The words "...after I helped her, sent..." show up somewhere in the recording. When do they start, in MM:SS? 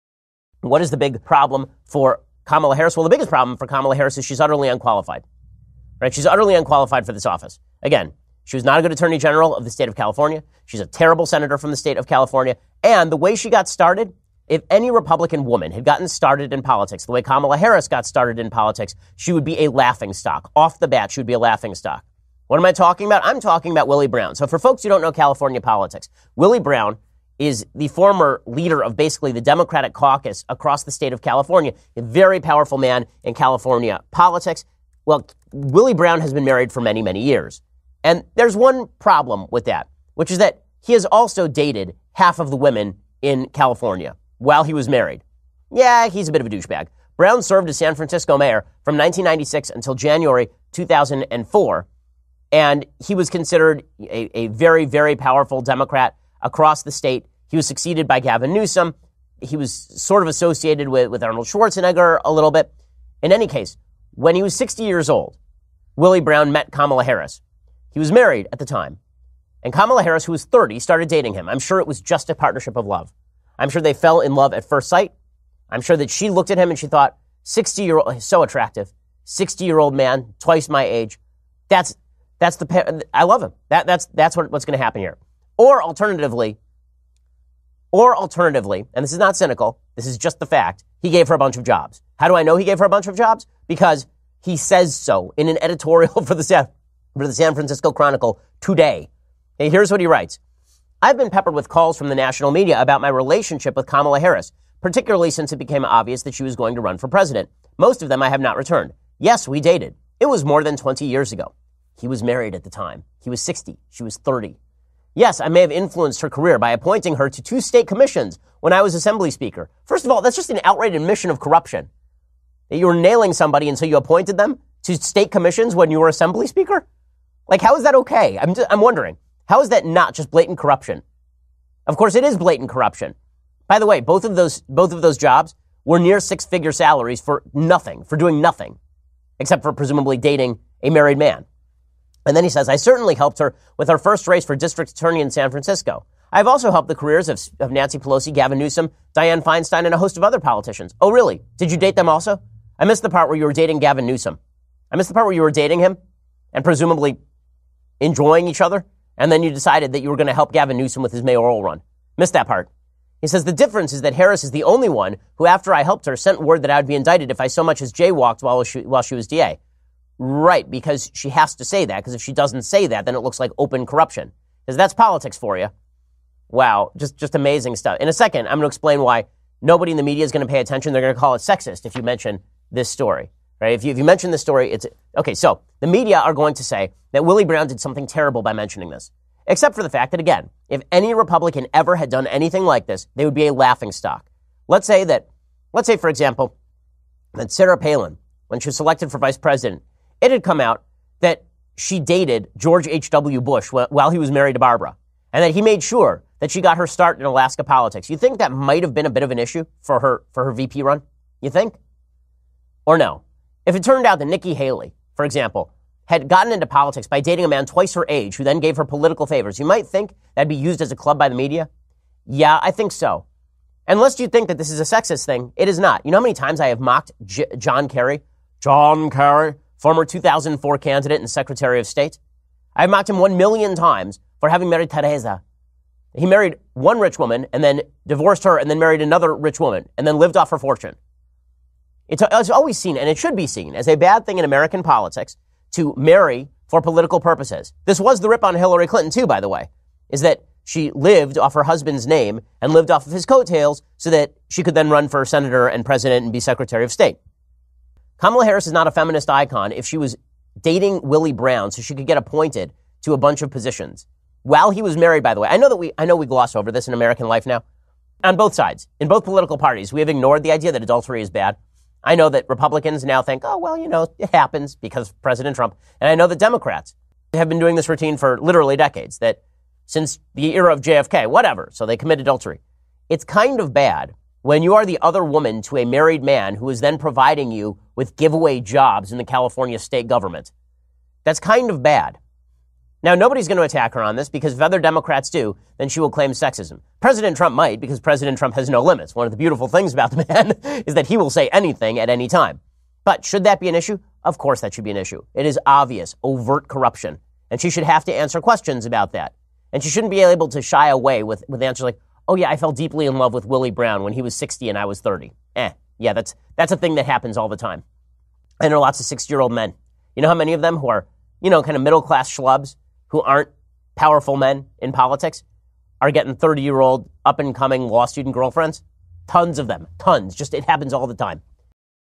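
02:45.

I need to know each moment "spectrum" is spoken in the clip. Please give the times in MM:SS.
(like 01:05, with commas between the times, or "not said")
not said.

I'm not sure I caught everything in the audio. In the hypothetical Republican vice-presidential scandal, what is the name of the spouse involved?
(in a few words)
Barbara.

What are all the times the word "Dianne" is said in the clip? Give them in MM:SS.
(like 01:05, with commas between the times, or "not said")
02:29.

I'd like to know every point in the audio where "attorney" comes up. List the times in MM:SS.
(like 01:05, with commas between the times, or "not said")
00:08, 02:24.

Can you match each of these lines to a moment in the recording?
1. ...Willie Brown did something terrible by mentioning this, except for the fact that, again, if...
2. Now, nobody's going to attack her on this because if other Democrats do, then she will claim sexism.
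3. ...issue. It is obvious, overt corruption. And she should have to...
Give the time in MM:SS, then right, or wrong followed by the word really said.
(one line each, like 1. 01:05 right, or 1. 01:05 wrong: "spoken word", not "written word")
1. 03:07 right
2. 04:53 right
3. 05:04 right.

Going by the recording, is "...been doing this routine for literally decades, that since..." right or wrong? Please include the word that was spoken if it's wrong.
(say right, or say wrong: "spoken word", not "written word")
right.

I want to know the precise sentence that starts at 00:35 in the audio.
Well, Willie Brown has been married for many, many years.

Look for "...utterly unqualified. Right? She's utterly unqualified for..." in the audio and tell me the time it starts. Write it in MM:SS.
00:04.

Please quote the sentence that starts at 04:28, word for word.
On both sides, in both political parties, we have ignored the idea that adultery is bad.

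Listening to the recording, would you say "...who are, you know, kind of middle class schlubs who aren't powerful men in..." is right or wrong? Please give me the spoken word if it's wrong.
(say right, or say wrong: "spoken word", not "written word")
right.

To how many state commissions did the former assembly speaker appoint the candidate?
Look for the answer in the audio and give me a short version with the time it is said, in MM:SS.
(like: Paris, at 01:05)
2, at 01:57.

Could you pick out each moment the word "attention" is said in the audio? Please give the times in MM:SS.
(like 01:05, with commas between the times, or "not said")
03:00.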